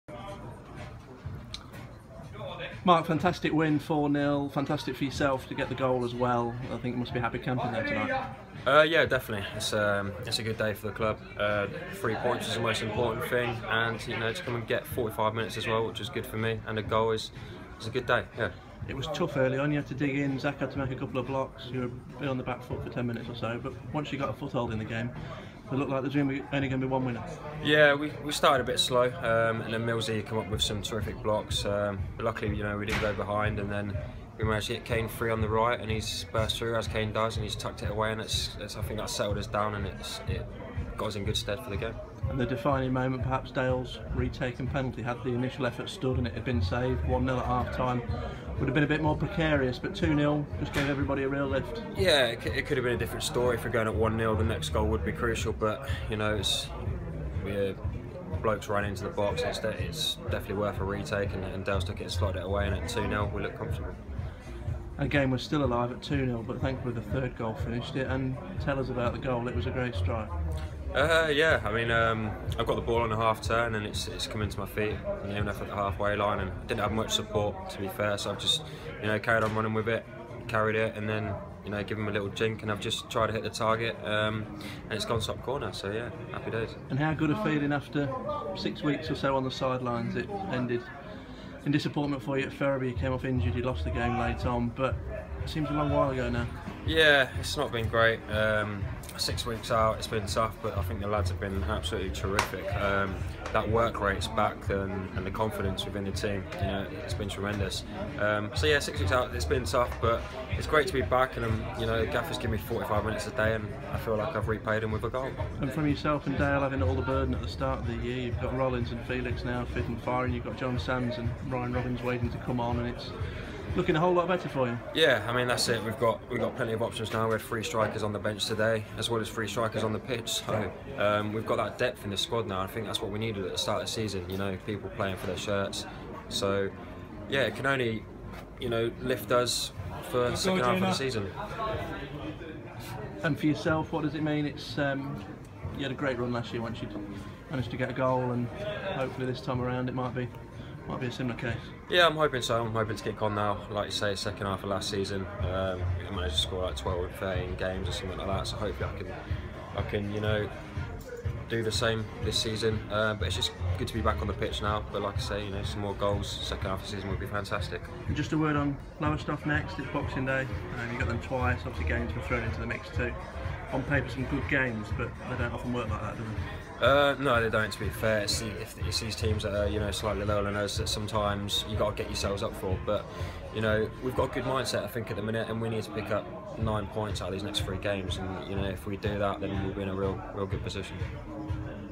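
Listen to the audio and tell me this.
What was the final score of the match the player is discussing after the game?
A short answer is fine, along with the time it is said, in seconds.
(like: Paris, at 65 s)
4-0, at 3 s.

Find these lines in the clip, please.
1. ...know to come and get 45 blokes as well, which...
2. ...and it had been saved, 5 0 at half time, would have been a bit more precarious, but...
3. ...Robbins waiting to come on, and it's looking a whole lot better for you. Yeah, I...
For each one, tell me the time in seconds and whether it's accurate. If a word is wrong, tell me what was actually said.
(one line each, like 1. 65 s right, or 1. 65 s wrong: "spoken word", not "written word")
1. 14 s wrong: "minutes", not "blokes"
2. 46 s wrong: "1", not "5"
3. 121 s right.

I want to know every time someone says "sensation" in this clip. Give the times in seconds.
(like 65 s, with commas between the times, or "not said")
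not said.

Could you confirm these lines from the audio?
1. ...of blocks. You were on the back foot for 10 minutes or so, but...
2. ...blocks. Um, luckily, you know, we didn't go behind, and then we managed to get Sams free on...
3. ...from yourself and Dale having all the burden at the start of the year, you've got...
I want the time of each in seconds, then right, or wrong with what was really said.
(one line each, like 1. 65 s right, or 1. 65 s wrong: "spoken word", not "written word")
1. 21 s right
2. 31 s wrong: "Kane", not "Sams"
3. 115 s right.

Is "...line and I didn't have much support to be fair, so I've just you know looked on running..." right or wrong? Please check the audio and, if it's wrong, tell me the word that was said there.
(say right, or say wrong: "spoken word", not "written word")
wrong: "carried", not "looked".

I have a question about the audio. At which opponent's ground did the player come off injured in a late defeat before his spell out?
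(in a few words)
Ferriby.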